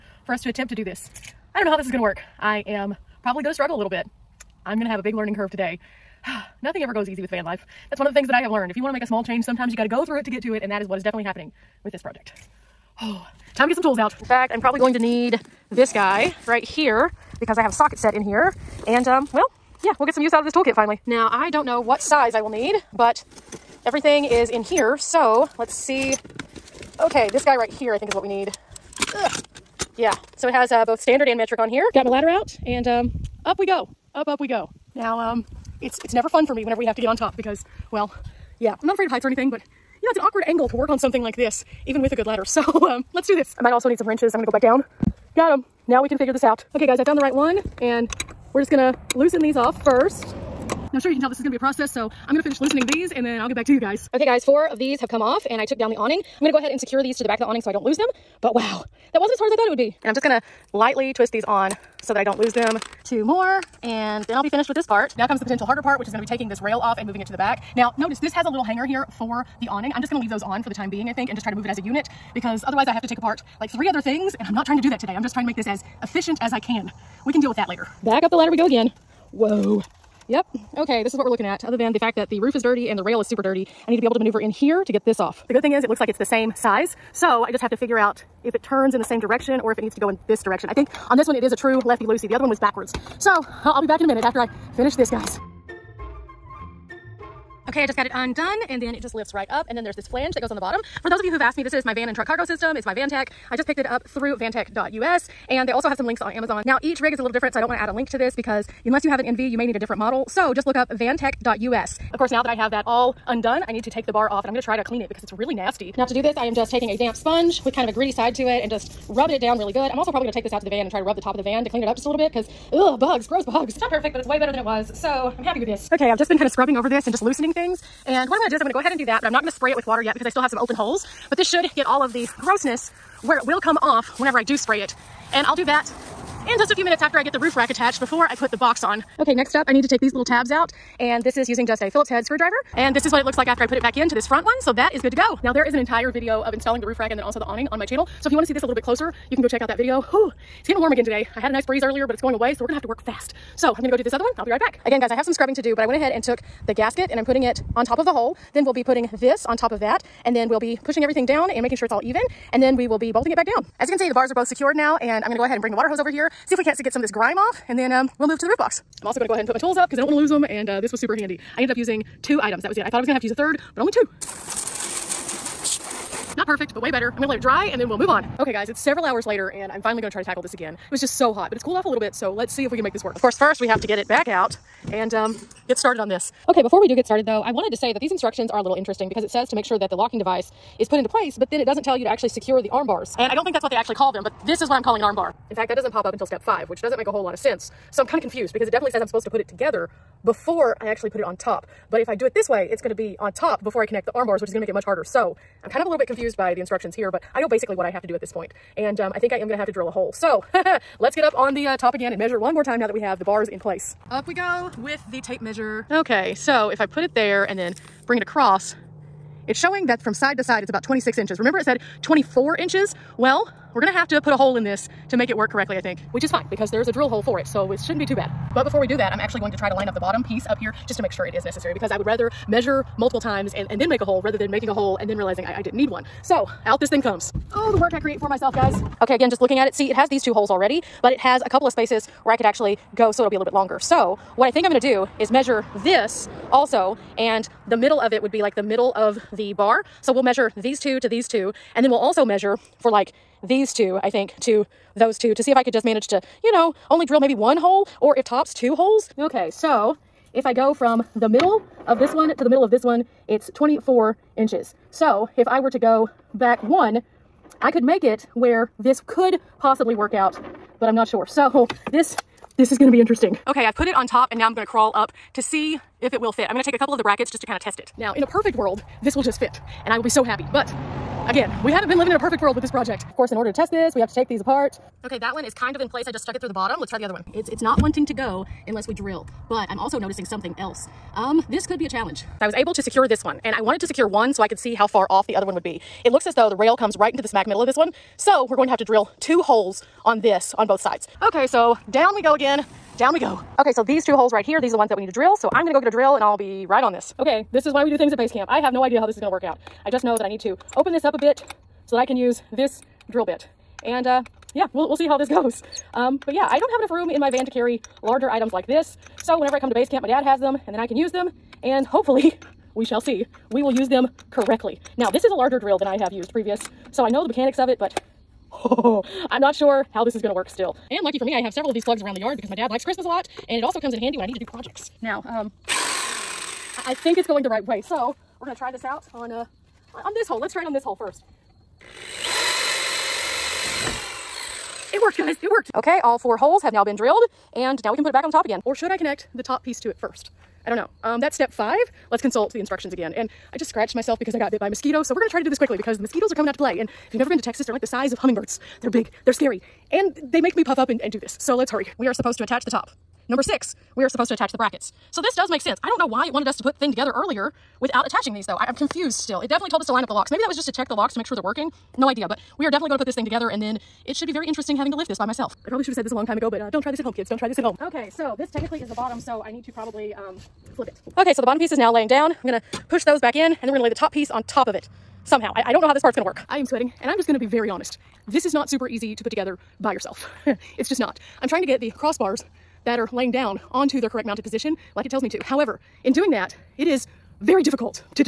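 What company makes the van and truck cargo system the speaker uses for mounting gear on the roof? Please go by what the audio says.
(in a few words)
Vantech.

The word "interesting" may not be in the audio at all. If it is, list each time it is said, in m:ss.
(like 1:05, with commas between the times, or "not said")
3:08, 4:33, 6:14.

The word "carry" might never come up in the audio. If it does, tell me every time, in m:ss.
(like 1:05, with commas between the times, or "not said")
5:17.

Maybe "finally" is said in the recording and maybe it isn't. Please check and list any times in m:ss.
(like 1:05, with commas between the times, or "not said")
0:20, 2:59.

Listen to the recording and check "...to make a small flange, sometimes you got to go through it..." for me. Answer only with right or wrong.
wrong.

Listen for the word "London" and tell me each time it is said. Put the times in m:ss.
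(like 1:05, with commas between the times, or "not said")
not said.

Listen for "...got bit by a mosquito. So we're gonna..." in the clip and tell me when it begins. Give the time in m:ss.
5:54.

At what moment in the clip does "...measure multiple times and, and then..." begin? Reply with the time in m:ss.
3:52.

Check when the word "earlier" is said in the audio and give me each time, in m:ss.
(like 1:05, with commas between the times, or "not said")
2:31, 6:07.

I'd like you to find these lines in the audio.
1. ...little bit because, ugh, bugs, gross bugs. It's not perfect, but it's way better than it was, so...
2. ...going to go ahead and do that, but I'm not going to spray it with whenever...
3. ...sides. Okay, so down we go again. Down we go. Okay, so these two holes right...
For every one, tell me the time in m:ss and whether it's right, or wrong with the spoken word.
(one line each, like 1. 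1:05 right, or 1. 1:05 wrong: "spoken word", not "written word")
1. 2:02 right
2. 2:08 wrong: "water", not "whenever"
3. 5:00 right.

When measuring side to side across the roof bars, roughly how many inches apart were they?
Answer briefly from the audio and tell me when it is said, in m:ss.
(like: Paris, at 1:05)
26 inches, at 3:40.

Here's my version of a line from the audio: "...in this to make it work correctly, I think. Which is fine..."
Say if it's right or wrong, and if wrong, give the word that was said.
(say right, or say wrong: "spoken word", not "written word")
right.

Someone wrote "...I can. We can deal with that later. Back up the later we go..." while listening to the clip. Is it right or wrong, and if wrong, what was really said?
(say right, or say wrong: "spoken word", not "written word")
wrong: "ladder", not "later".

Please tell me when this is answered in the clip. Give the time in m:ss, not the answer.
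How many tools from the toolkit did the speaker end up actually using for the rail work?
2:51.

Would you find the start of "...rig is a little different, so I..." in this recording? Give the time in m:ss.
1:46.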